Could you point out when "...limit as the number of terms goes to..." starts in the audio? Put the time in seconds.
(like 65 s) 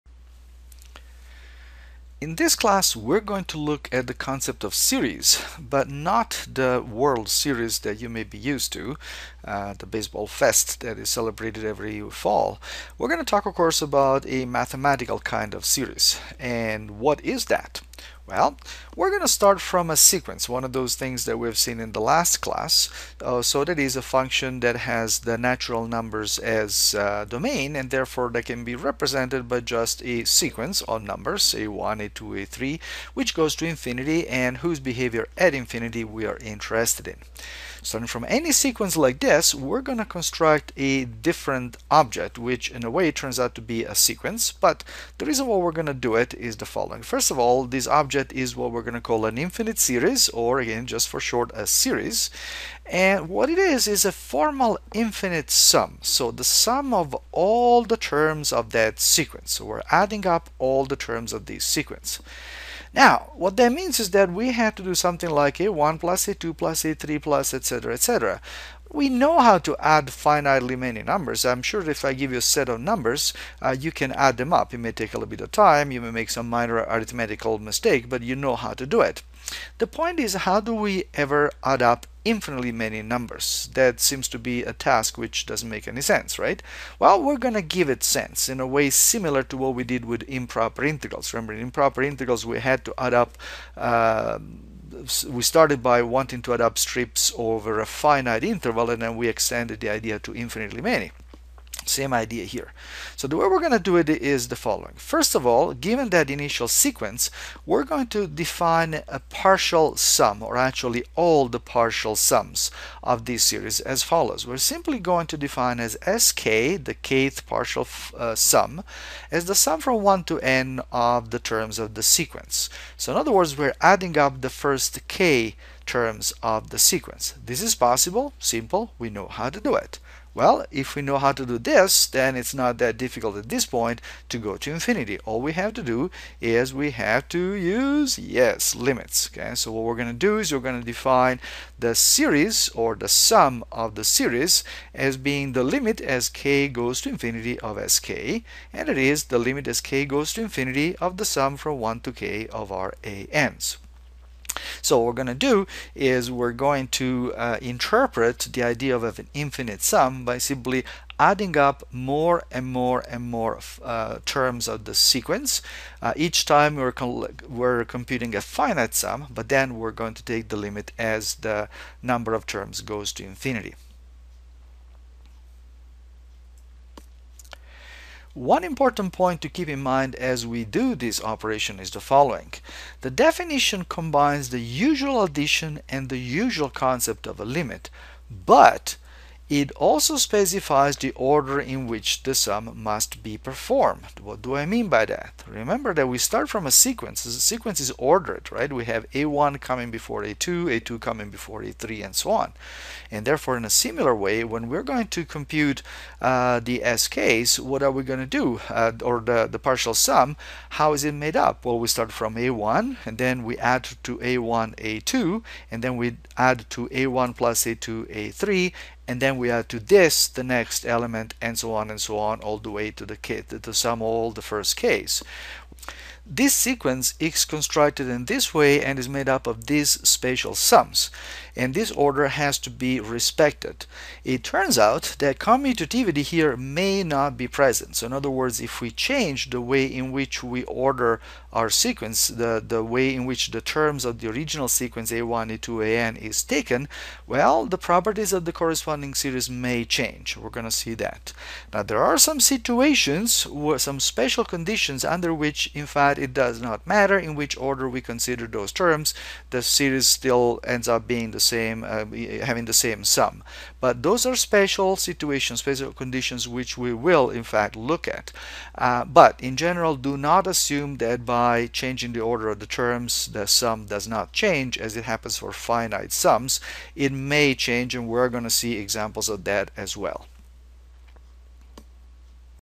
170 s.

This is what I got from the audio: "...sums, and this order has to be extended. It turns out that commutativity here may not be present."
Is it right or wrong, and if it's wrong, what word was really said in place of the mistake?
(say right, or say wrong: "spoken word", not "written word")
wrong: "respected", not "extended".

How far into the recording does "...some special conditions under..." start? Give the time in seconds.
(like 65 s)
253 s.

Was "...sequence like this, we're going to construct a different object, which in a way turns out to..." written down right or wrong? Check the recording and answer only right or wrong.
right.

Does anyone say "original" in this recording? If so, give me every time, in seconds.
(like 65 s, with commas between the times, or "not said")
244 s.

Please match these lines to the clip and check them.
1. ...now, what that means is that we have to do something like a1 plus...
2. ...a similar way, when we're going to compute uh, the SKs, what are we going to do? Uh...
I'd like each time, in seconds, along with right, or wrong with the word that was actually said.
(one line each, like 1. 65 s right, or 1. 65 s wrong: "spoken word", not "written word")
1. 62 s right
2. 203 s right.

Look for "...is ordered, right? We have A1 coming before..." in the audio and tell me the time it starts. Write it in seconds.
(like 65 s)
197 s.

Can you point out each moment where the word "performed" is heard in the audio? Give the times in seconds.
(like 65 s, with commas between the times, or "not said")
193 s.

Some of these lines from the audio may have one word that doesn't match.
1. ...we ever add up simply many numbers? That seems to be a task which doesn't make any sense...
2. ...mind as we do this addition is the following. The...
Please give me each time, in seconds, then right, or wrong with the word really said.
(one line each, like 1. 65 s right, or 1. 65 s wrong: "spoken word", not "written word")
1. 80 s wrong: "infinitely", not "simply"
2. 179 s wrong: "operation", not "addition".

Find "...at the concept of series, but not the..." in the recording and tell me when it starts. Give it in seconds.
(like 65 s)
3 s.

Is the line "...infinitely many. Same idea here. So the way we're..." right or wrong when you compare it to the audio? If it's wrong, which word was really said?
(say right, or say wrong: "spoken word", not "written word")
right.